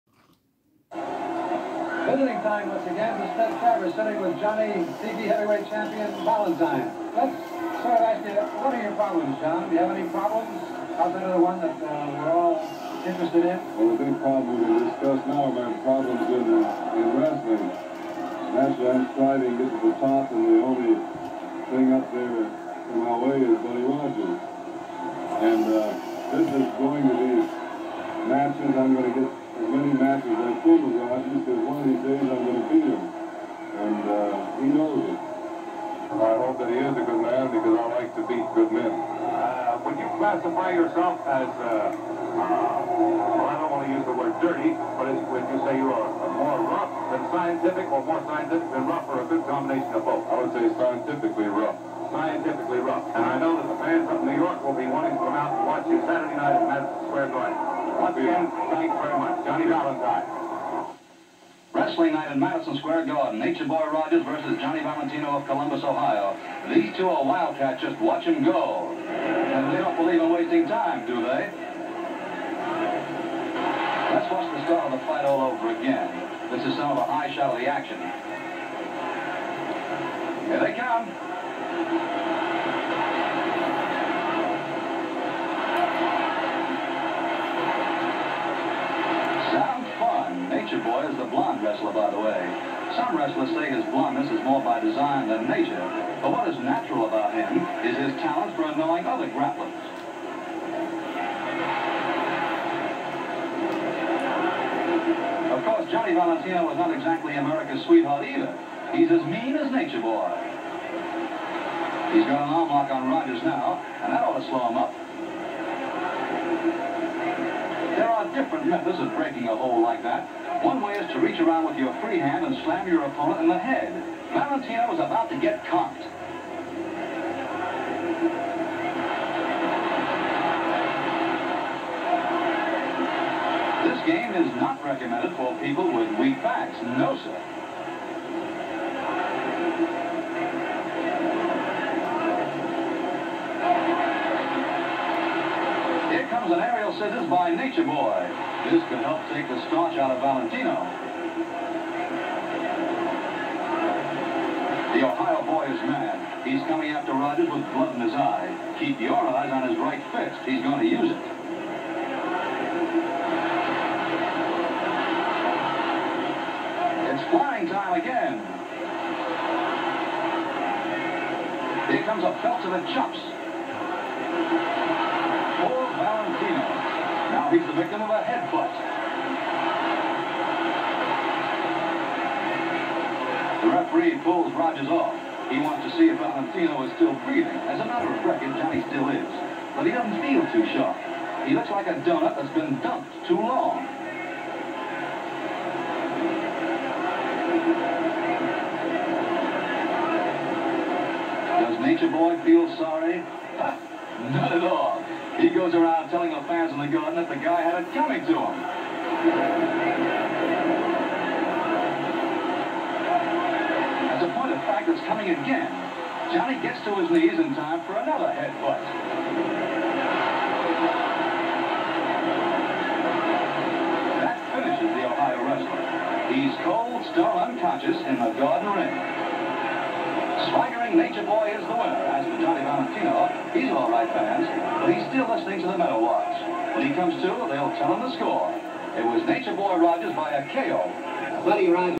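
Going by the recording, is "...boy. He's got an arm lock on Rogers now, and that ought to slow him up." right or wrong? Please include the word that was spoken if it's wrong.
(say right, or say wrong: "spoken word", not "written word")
right.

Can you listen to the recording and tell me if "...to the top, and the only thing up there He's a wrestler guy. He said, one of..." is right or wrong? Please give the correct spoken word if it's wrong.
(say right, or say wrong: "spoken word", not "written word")
wrong: "receiver", not "wrestler".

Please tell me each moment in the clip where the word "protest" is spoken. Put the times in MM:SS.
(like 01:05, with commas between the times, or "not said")
not said.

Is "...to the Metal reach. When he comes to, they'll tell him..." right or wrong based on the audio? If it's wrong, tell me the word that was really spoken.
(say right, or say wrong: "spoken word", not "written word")
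wrong: "watch", not "reach".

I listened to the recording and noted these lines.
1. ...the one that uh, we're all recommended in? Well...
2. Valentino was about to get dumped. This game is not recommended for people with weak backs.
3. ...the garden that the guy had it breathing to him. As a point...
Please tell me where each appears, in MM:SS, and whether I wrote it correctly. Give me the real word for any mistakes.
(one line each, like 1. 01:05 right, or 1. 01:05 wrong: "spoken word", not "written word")
1. 00:11 wrong: "interested", not "recommended"
2. 02:04 wrong: "cocked", not "dumped"
3. 03:26 wrong: "coming", not "breathing".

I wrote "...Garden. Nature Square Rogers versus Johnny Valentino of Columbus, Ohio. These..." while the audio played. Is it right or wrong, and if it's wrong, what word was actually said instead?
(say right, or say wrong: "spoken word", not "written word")
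wrong: "Boy", not "Square".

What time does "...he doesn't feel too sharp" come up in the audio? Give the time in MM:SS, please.
03:09.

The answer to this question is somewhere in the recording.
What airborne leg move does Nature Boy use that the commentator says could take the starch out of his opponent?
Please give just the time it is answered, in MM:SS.
02:26.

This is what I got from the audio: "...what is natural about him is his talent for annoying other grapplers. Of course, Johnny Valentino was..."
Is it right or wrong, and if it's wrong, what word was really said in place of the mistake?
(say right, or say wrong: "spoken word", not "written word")
right.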